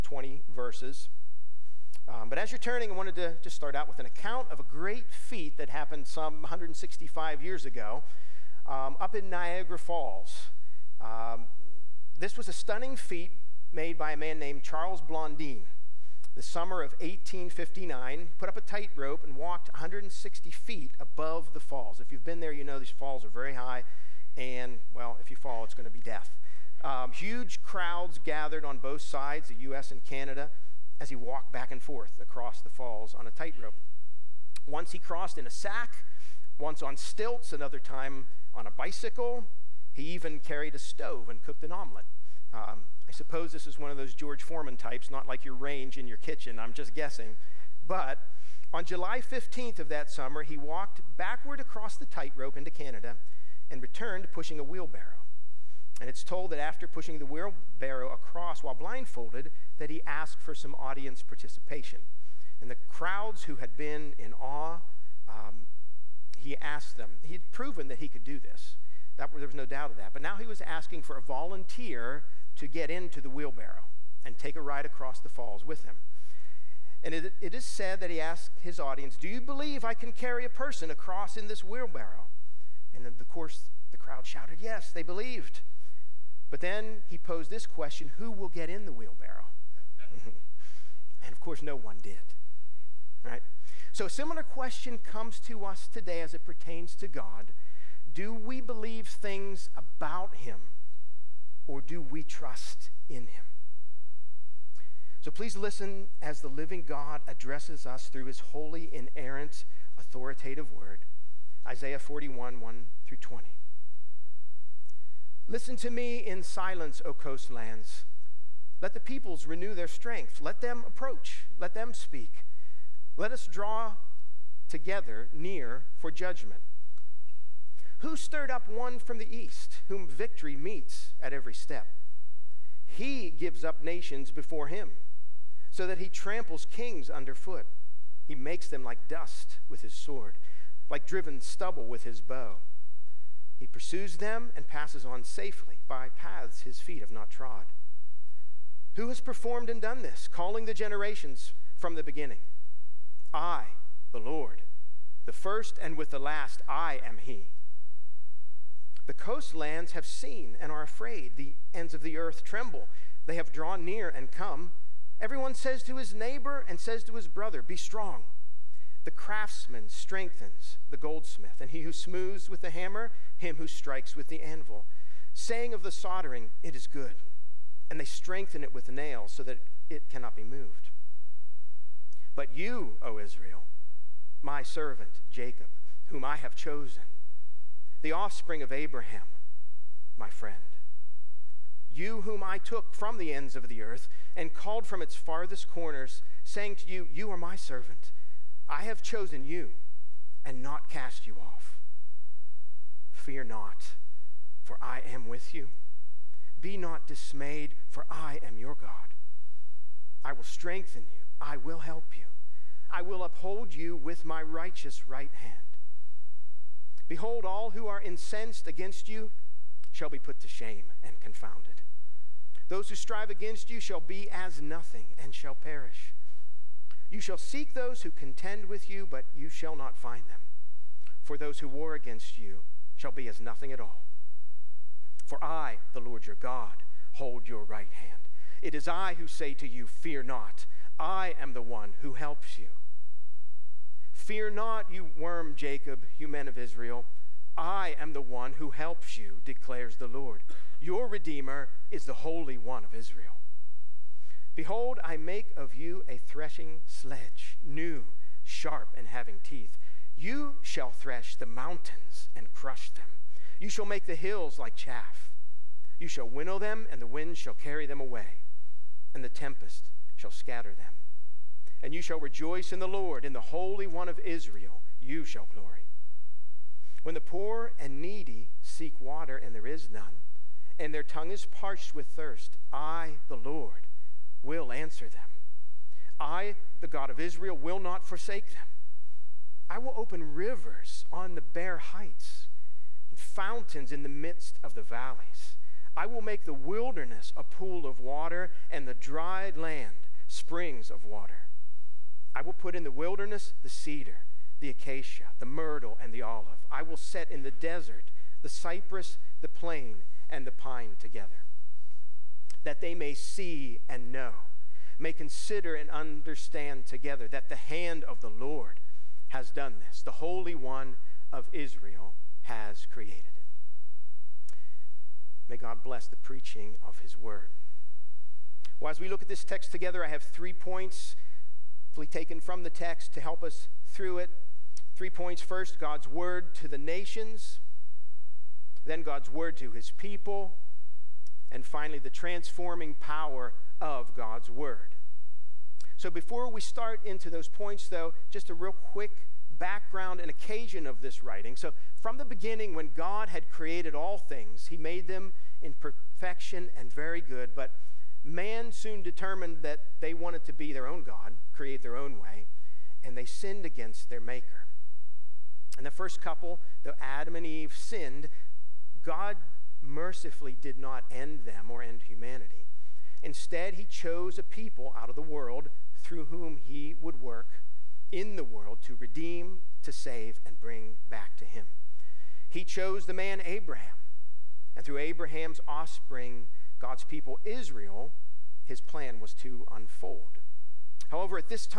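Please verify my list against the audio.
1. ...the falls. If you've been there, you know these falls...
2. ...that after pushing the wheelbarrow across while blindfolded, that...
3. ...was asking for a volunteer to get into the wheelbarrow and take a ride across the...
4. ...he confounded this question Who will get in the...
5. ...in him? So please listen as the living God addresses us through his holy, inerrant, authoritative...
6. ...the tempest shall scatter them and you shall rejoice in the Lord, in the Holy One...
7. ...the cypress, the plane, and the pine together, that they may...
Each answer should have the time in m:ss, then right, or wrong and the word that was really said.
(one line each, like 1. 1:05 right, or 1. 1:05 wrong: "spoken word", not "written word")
1. 0:21 right
2. 0:56 right
3. 1:10 right
4. 1:27 wrong: "posed", not "confounded"
5. 1:43 right
6. 4:29 right
7. 5:08 right.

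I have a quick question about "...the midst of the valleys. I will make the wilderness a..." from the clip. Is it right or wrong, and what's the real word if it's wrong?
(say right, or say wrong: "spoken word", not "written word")
right.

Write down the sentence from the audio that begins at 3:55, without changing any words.
For I, the Lord your God, hold your right hand.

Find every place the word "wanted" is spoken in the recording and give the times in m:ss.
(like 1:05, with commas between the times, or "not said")
0:02, 6:00.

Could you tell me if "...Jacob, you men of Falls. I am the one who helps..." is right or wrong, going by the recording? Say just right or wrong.
wrong.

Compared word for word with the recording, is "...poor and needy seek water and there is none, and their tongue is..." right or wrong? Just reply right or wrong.
right.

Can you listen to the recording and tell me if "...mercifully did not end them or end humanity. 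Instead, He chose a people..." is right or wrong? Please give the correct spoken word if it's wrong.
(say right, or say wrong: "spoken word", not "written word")
right.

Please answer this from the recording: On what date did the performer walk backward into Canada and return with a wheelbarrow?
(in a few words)
July 15th.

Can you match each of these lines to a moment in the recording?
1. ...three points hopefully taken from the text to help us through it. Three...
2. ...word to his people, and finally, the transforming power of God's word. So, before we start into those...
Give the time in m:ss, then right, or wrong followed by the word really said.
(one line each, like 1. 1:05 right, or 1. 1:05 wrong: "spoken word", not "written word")
1. 5:30 right
2. 5:39 right.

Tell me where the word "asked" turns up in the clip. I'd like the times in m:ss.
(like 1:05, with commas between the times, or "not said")
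1:00, 1:06, 1:18.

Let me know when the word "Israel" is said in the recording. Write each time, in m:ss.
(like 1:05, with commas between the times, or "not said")
3:03, 4:06, 4:12, 4:34, 4:47, 5:21, 6:27.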